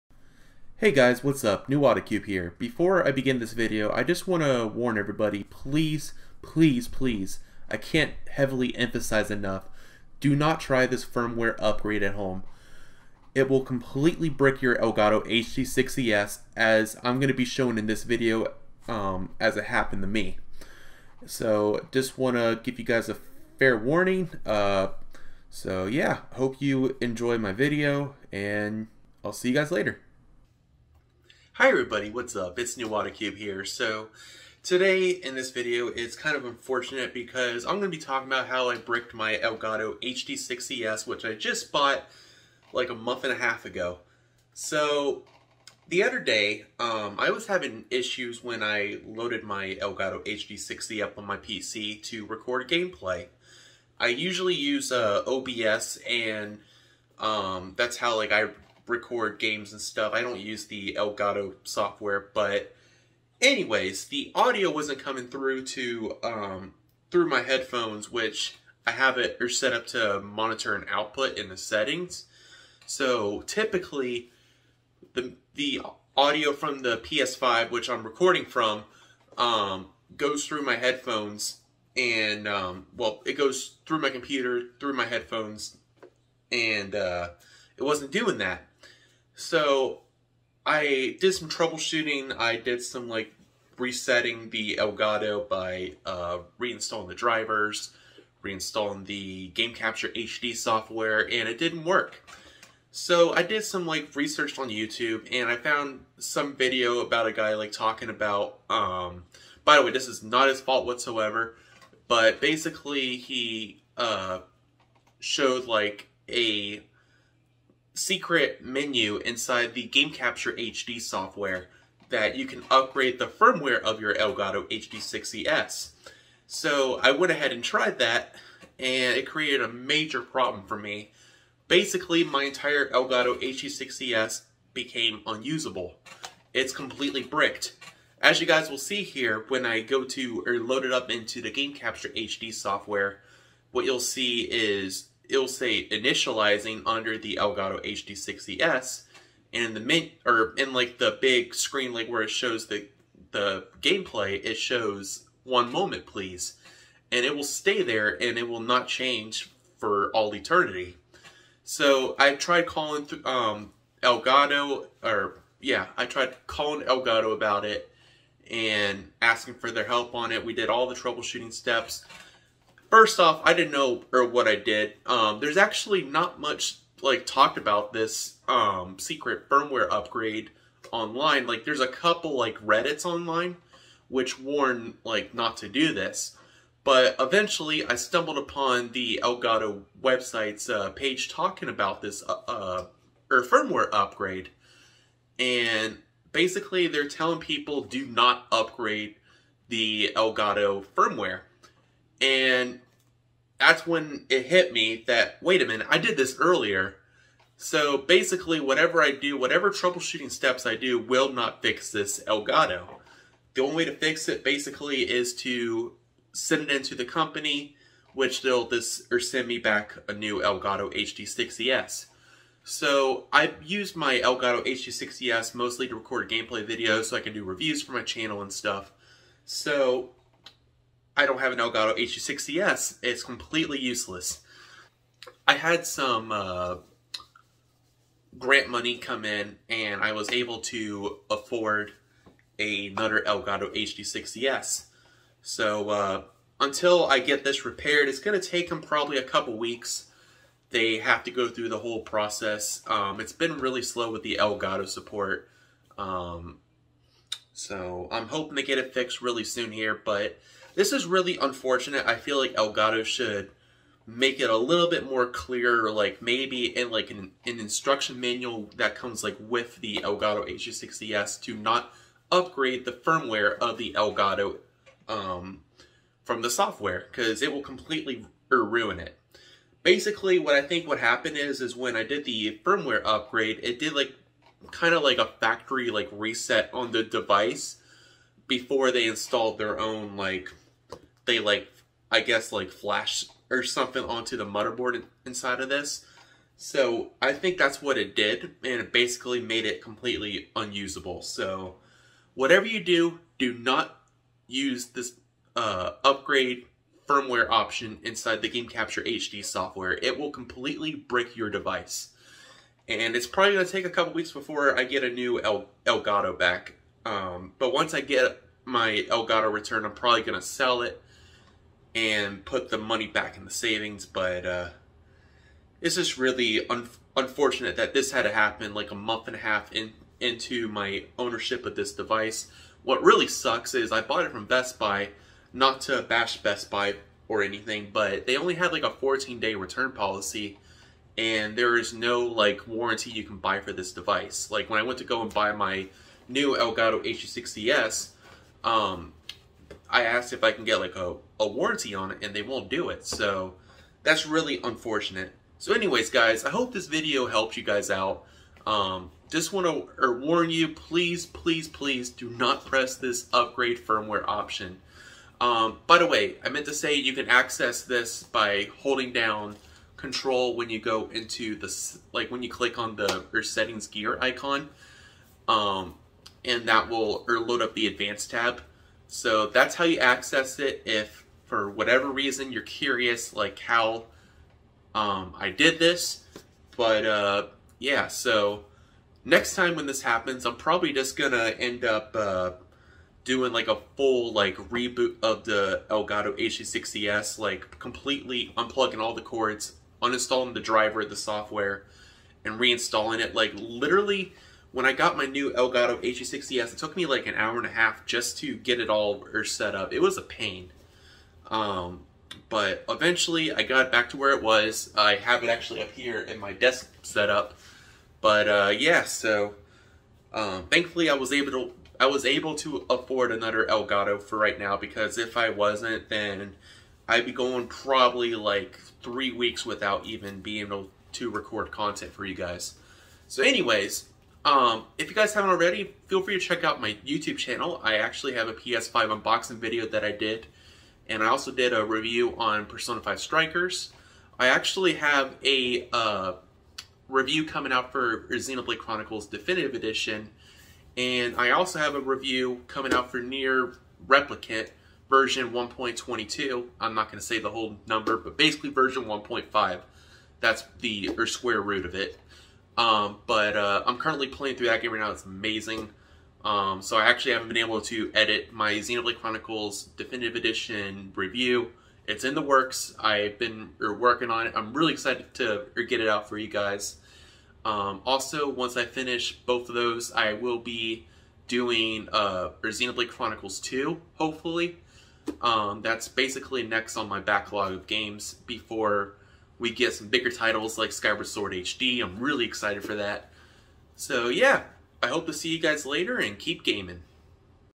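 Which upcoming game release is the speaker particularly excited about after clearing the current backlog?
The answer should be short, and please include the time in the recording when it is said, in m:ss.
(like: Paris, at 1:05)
Skyward Sword HD, at 8:10.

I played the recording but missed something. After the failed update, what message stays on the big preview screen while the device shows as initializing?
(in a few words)
One moment please.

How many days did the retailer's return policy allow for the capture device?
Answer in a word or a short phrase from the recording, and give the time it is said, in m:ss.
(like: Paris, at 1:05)
14, at 5:38.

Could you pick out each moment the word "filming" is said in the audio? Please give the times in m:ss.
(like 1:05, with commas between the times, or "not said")
not said.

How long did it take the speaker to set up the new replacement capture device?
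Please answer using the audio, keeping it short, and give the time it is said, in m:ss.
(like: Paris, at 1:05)
An hour and a half, at 6:47.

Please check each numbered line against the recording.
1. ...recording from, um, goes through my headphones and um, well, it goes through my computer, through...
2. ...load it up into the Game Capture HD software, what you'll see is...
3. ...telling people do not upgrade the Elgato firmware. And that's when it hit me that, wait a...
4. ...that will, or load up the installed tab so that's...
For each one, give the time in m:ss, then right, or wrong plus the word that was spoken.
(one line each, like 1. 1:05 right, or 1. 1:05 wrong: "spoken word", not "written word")
1. 1:18 right
2. 2:20 right
3. 3:17 right
4. 6:16 wrong: "advanced", not "installed".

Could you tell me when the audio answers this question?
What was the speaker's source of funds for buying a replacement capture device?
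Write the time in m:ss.
3:58.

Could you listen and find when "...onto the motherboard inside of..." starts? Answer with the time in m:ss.
4:54.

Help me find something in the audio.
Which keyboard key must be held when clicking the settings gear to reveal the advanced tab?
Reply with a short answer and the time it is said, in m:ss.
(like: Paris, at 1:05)
Control, at 6:09.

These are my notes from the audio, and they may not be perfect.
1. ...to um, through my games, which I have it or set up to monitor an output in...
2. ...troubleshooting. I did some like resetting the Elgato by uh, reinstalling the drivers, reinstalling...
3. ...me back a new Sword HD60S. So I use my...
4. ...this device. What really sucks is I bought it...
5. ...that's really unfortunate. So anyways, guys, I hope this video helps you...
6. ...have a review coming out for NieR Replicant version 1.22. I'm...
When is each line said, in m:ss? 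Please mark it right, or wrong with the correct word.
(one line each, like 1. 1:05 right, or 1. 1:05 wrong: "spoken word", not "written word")
1. 1:05 wrong: "headphones", not "games"
2. 1:31 right
3. 3:39 wrong: "Elgato", not "Sword"
4. 5:31 right
5. 5:54 right
6. 7:31 right.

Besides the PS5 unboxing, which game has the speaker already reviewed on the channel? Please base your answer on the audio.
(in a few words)
Persona 5 Strikers.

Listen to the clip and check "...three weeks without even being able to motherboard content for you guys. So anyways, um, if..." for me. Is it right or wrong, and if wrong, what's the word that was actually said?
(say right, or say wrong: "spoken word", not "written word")
wrong: "record", not "motherboard".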